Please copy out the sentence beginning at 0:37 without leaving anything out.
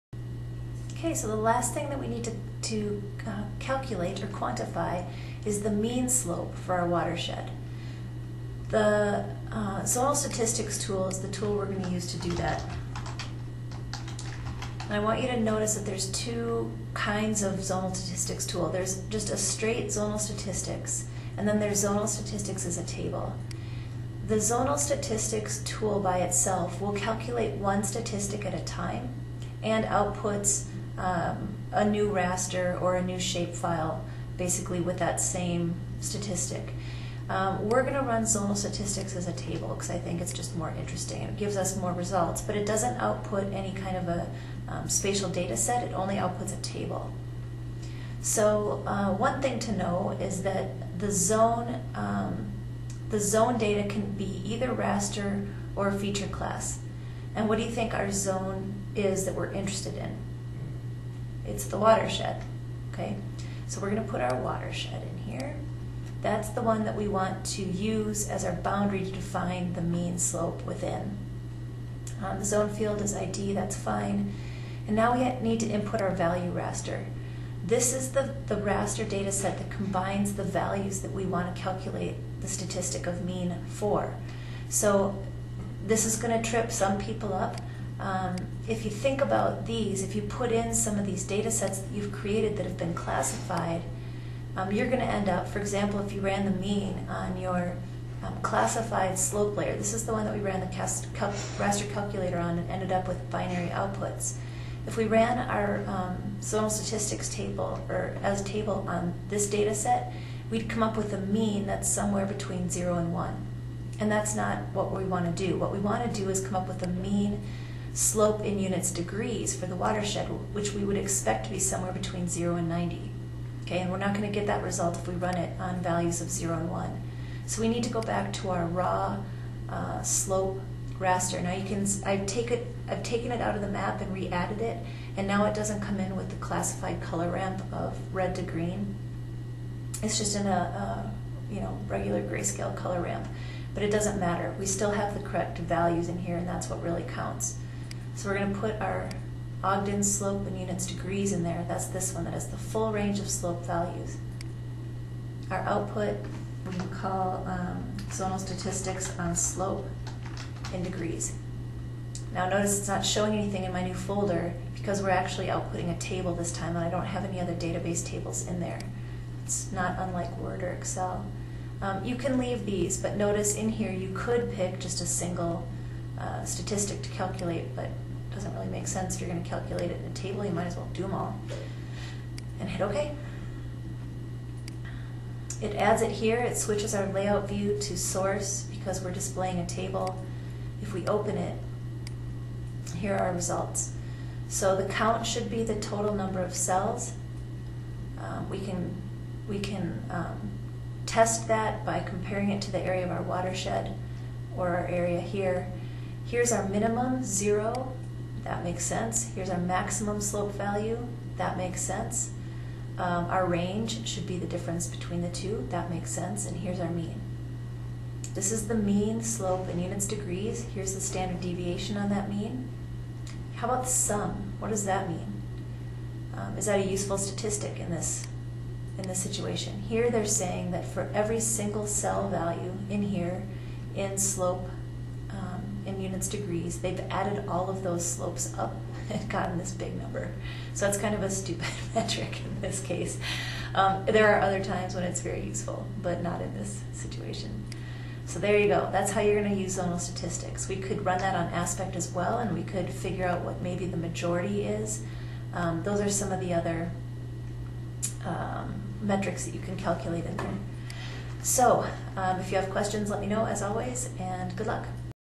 Um, we're going to run zonal statistics as a table because I think it's just more interesting.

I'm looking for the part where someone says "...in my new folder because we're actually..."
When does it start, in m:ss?
2:43.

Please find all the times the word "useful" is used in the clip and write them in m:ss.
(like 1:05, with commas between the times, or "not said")
3:46, 4:05.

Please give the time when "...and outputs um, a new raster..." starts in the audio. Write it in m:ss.
0:29.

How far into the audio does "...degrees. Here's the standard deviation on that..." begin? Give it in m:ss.
3:40.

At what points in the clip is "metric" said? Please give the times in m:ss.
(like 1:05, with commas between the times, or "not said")
4:01, 4:19.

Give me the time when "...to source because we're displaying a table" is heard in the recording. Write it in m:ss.
3:07.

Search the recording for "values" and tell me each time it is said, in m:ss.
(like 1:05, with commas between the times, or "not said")
1:16, 1:20, 2:05, 2:25, 2:33, 3:30, 3:52.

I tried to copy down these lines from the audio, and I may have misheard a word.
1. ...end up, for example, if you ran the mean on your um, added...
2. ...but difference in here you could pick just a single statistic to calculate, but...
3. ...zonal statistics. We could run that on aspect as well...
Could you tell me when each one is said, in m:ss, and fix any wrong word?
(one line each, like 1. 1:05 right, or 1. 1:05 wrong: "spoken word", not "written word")
1. 1:35 wrong: "classified", not "added"
2. 2:52 wrong: "notice", not "difference"
3. 4:09 right.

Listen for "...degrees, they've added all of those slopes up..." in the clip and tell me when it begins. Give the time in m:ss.
3:56.